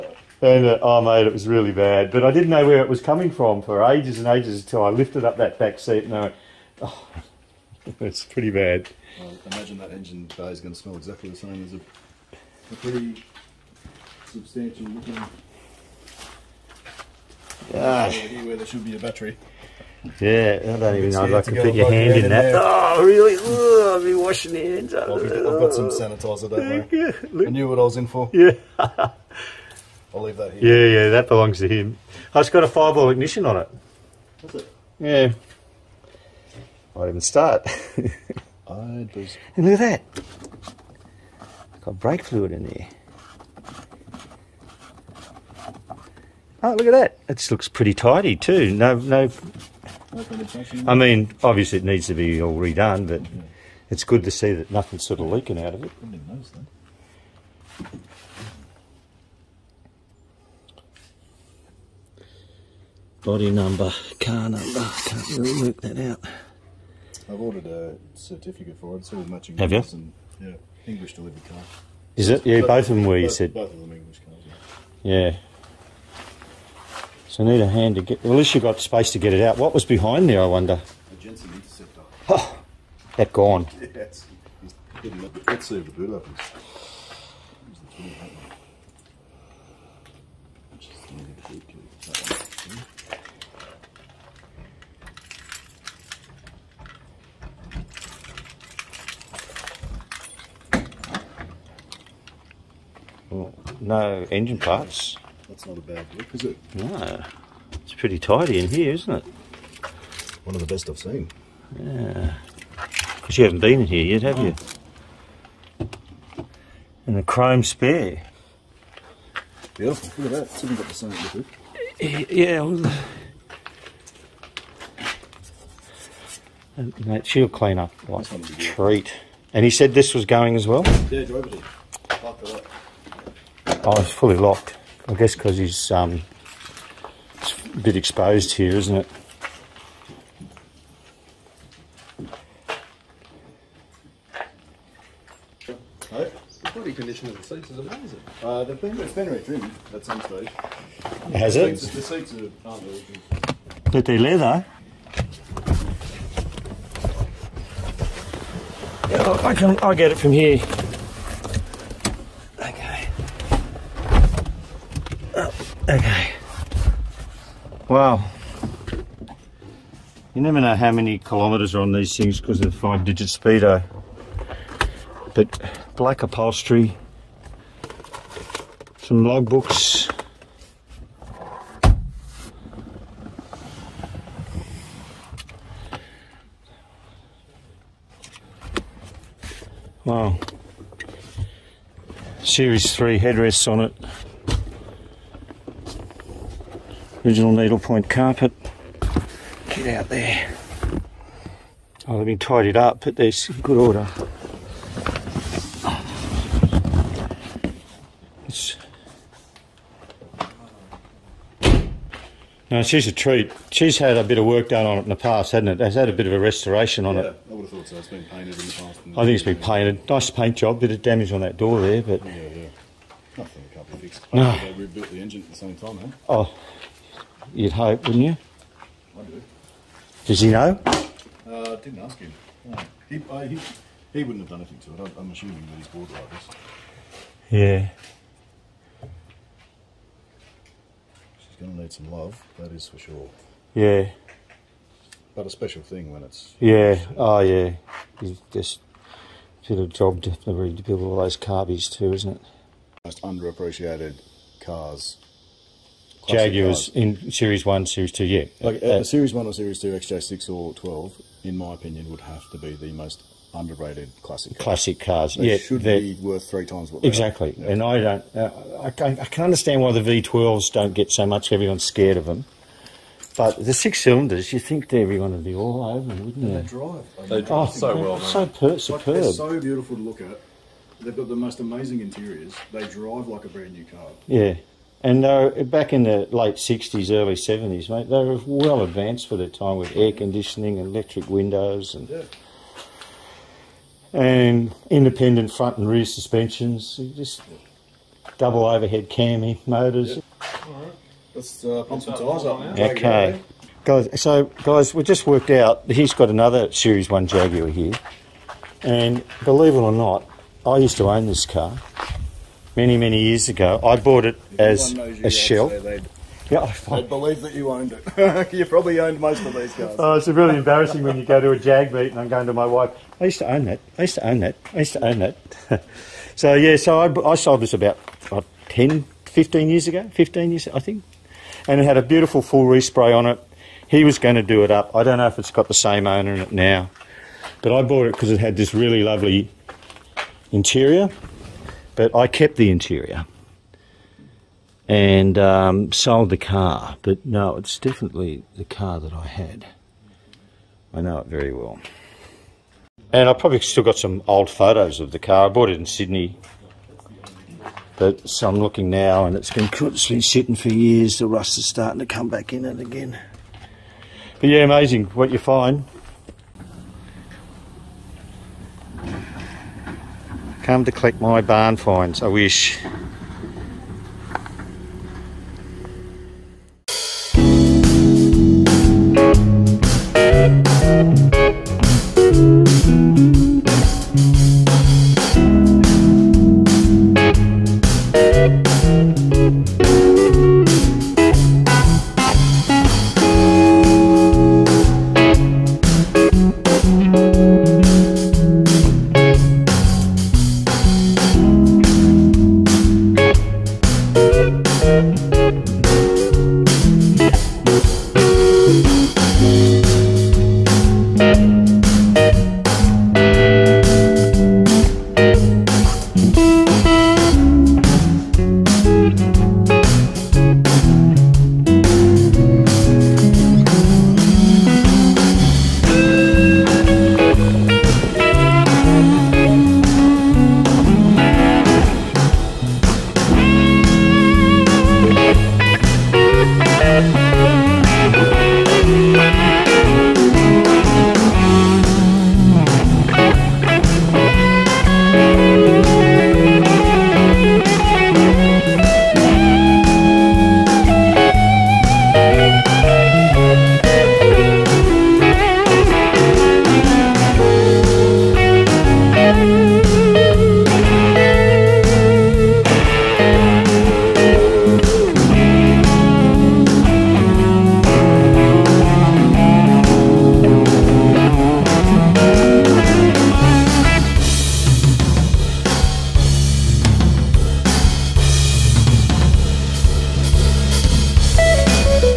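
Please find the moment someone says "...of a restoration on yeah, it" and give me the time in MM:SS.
03:36.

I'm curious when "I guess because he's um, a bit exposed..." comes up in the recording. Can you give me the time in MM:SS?
02:15.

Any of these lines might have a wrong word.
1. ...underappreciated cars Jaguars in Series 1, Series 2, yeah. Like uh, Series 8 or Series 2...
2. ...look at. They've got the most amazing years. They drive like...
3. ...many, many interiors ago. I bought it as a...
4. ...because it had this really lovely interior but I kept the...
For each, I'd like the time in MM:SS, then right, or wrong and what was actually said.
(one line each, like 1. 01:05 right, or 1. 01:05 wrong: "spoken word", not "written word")
1. 04:13 wrong: "1", not "8"
2. 04:40 wrong: "interiors", not "years"
3. 05:12 wrong: "years", not "interiors"
4. 05:38 right.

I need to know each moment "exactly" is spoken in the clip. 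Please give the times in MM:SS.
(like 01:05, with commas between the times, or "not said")
00:10, 04:27.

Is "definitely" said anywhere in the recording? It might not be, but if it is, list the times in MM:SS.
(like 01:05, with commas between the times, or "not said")
04:10, 05:47.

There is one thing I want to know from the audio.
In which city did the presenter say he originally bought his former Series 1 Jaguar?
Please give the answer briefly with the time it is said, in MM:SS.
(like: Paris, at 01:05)
Sydney, at 05:55.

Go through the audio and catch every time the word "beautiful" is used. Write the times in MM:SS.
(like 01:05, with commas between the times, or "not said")
01:59, 04:39, 05:32.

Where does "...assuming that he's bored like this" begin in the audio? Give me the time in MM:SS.
03:55.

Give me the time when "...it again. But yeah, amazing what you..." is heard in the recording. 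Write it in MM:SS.
06:02.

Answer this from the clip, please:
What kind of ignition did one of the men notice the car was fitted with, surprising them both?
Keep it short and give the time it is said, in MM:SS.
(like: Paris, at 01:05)
Fireball ignition, at 00:32.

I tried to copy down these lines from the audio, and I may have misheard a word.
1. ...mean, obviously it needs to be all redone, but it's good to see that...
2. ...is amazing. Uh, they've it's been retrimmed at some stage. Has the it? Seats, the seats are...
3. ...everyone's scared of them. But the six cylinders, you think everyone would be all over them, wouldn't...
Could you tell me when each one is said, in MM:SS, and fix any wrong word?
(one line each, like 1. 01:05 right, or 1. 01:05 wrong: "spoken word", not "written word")
1. 00:50 right
2. 02:27 right
3. 04:31 right.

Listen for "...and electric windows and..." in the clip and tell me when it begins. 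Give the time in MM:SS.
04:50.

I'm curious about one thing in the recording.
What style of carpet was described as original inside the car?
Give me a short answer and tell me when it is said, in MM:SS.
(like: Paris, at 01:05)
Needlepoint, at 03:17.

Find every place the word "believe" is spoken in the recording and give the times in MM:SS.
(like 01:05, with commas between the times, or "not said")
05:09, 05:17.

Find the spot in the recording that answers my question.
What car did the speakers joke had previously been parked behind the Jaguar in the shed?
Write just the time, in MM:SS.
01:21.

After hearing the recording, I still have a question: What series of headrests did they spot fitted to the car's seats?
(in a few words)
Series 3.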